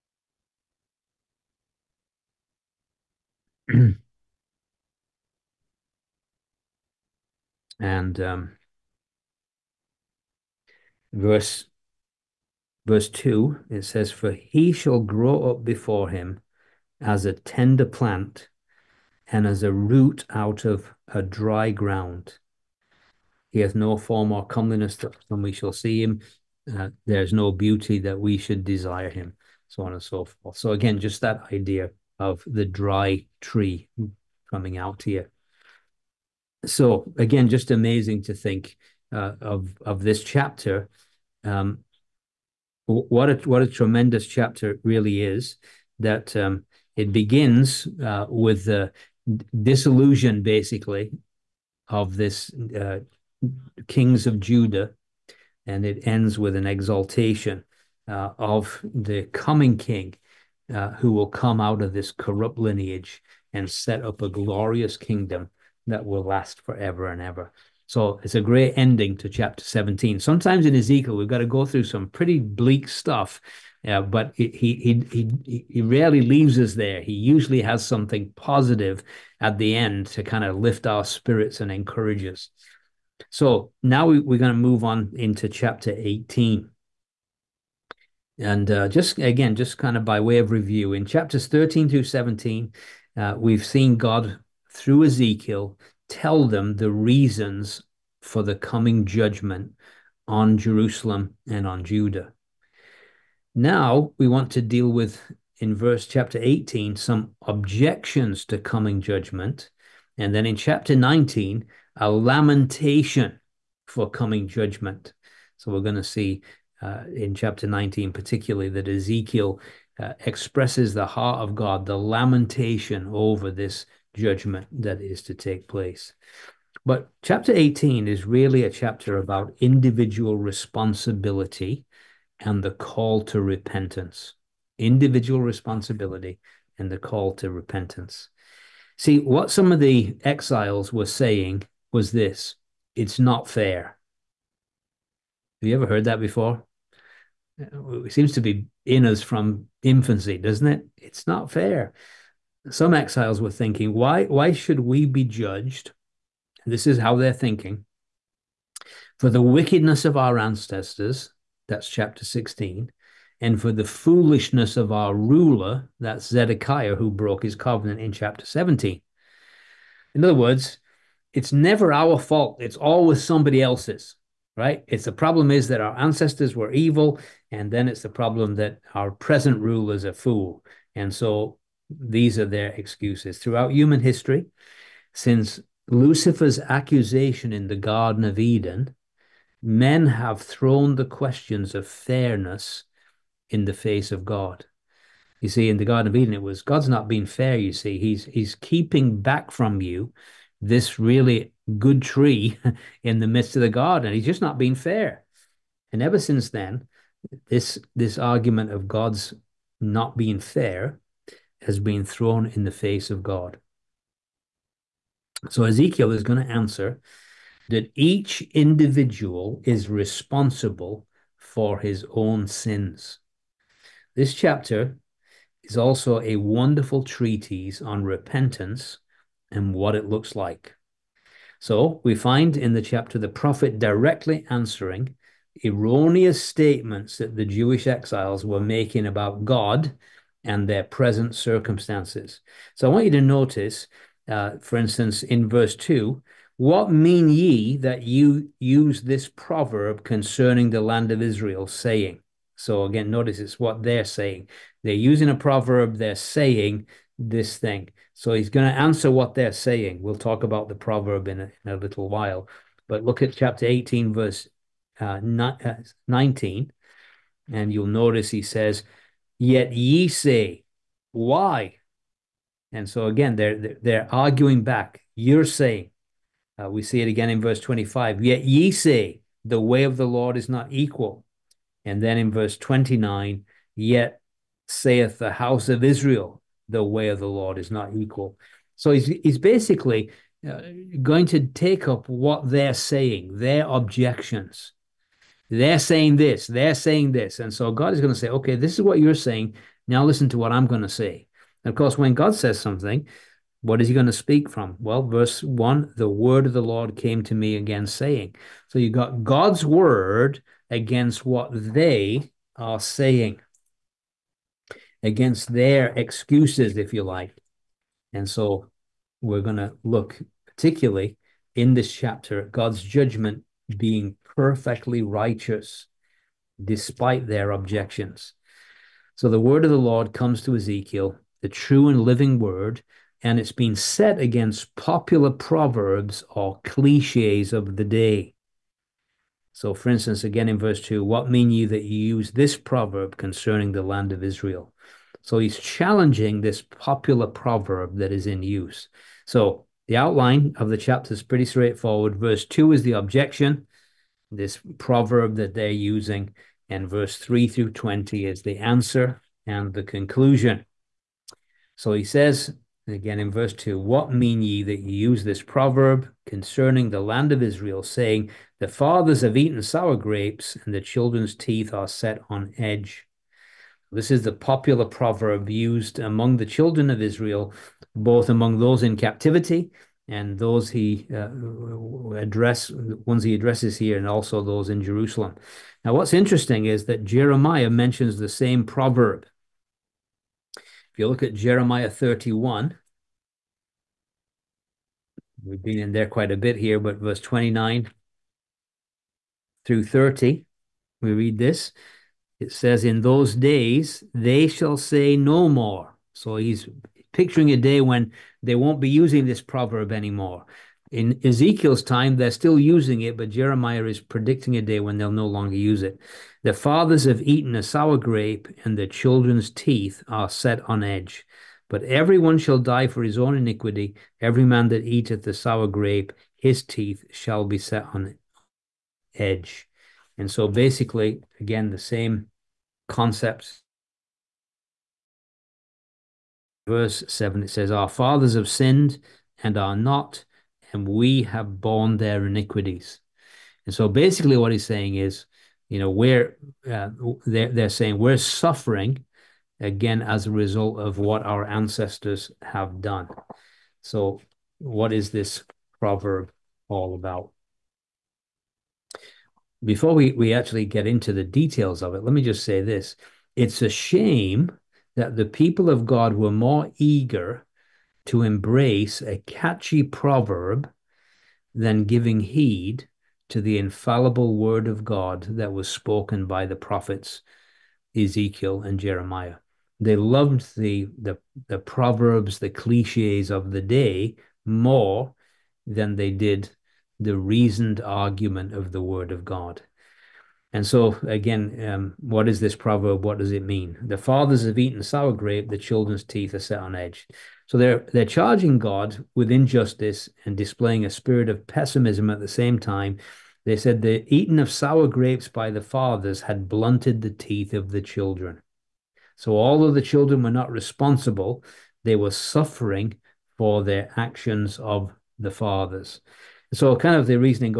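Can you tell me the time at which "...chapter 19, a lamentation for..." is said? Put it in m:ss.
1:50.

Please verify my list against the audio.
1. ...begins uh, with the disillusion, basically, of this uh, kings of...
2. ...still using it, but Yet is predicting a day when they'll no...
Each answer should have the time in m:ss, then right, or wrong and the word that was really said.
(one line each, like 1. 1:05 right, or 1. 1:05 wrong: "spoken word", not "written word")
1. 0:47 right
2. 6:52 wrong: "Jeremiah", not "Yet".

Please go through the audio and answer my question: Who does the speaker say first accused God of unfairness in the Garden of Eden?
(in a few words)
Lucifer.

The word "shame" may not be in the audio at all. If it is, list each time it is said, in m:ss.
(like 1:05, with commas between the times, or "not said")
7:43.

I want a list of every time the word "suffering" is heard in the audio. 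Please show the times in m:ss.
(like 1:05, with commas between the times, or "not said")
7:28, 8:32.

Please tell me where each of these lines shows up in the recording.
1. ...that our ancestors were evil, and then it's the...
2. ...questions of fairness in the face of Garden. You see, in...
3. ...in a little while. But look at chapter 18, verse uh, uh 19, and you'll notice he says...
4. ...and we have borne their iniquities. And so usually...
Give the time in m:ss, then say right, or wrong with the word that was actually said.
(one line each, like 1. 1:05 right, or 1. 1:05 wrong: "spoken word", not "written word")
1. 2:55 right
2. 3:11 wrong: "God", not "Garden"
3. 4:21 right
4. 7:20 wrong: "basically", not "usually".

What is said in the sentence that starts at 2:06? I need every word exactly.
But chapter 18 is really a chapter about individual responsibility and the call to repentance.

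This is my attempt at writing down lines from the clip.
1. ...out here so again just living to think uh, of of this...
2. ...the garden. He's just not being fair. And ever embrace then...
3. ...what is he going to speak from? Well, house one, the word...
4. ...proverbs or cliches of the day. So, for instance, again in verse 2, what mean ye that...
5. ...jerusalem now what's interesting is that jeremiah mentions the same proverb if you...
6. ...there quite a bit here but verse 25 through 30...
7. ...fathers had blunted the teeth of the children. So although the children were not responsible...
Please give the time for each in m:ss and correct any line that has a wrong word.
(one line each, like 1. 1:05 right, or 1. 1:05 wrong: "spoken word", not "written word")
1. 0:34 wrong: "amazing", not "living"
2. 3:23 wrong: "since", not "embrace"
3. 5:03 wrong: "verse", not "house"
4. 5:35 right
5. 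6:24 right
6. 6:35 wrong: "29", not "25"
7. 8:25 right.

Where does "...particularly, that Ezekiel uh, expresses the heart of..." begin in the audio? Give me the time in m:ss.
1:58.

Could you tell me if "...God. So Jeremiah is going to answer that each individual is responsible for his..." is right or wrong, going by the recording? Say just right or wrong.
wrong.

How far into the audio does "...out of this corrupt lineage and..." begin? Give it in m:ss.
1:01.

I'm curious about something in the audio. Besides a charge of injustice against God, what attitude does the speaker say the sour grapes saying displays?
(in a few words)
pessimism.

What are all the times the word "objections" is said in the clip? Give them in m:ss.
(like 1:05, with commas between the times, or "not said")
1:47, 4:53, 5:27, 5:52.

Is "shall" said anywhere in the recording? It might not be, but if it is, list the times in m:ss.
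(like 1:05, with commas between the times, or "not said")
0:14, 0:25, 6:44, 7:02, 7:07.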